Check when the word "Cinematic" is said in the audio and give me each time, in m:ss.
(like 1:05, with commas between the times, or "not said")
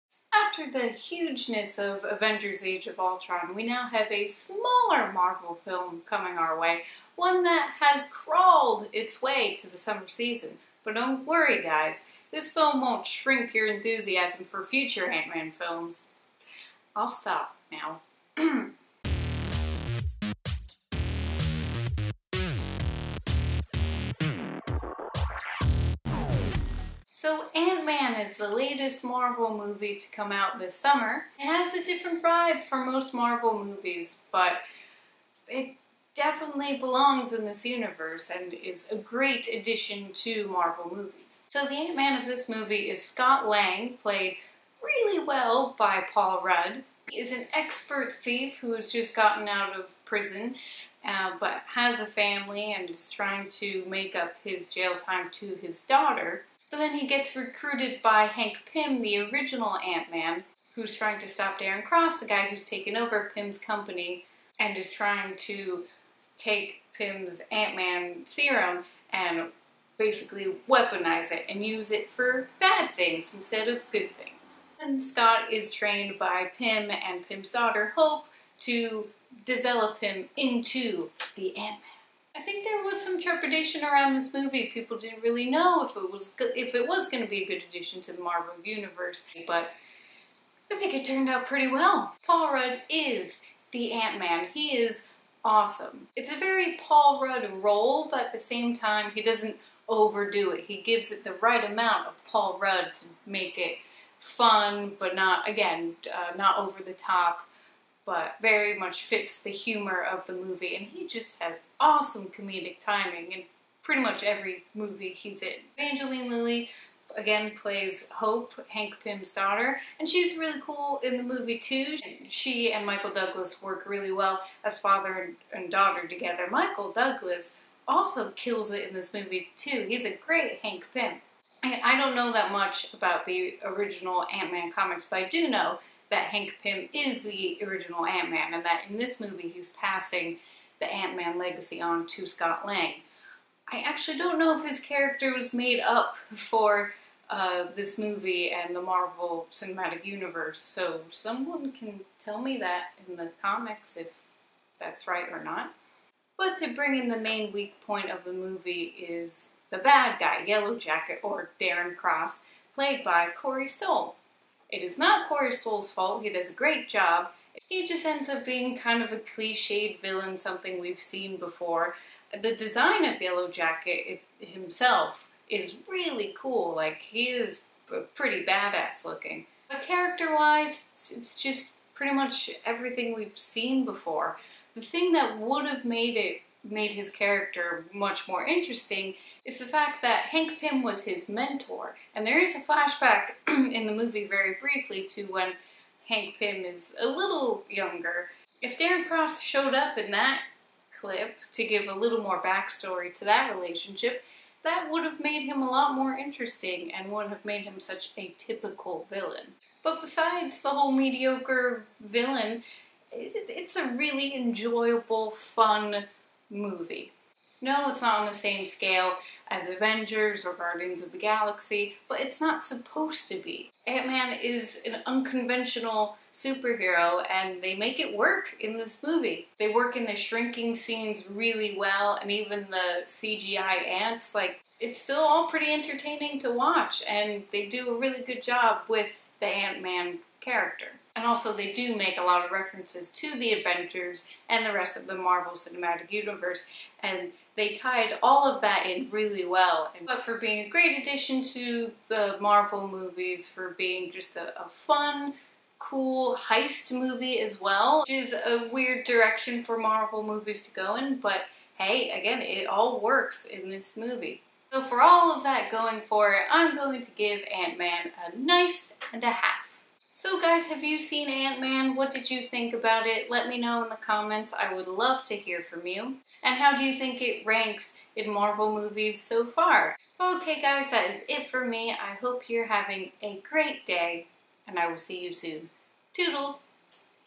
2:29, 4:05.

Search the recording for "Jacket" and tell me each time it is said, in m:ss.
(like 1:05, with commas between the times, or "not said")
2:40, 2:53.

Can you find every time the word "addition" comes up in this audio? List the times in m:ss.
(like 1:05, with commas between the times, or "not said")
0:39, 1:27, 4:10.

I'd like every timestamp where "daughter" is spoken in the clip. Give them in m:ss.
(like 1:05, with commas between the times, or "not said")
0:55, 1:17, 1:59, 2:05.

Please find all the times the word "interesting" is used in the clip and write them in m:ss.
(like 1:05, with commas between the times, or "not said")
3:08, 3:26.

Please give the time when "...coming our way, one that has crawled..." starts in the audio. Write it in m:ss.
0:06.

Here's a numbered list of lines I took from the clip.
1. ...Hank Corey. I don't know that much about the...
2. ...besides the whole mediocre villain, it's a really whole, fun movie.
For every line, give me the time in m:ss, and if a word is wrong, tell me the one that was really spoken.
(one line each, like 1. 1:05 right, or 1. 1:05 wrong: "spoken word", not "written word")
1. 2:10 wrong: "Pym", not "Corey"
2. 3:30 wrong: "enjoyable", not "whole".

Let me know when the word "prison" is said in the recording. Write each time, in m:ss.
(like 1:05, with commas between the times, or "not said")
0:50.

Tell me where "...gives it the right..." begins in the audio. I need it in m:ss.
1:40.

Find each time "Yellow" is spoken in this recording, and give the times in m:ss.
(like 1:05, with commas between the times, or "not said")
2:40, 2:53.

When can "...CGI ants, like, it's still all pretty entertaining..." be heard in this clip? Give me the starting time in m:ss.
3:53.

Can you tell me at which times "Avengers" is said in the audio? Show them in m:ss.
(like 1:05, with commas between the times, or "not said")
0:02, 3:39, 4:03.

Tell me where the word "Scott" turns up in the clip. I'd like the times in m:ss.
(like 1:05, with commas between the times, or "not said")
0:43, 1:15, 2:22.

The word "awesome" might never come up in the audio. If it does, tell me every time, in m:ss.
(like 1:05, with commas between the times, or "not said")
1:35, 1:51.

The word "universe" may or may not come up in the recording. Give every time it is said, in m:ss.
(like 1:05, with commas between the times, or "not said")
0:37, 1:28, 2:30, 4:06.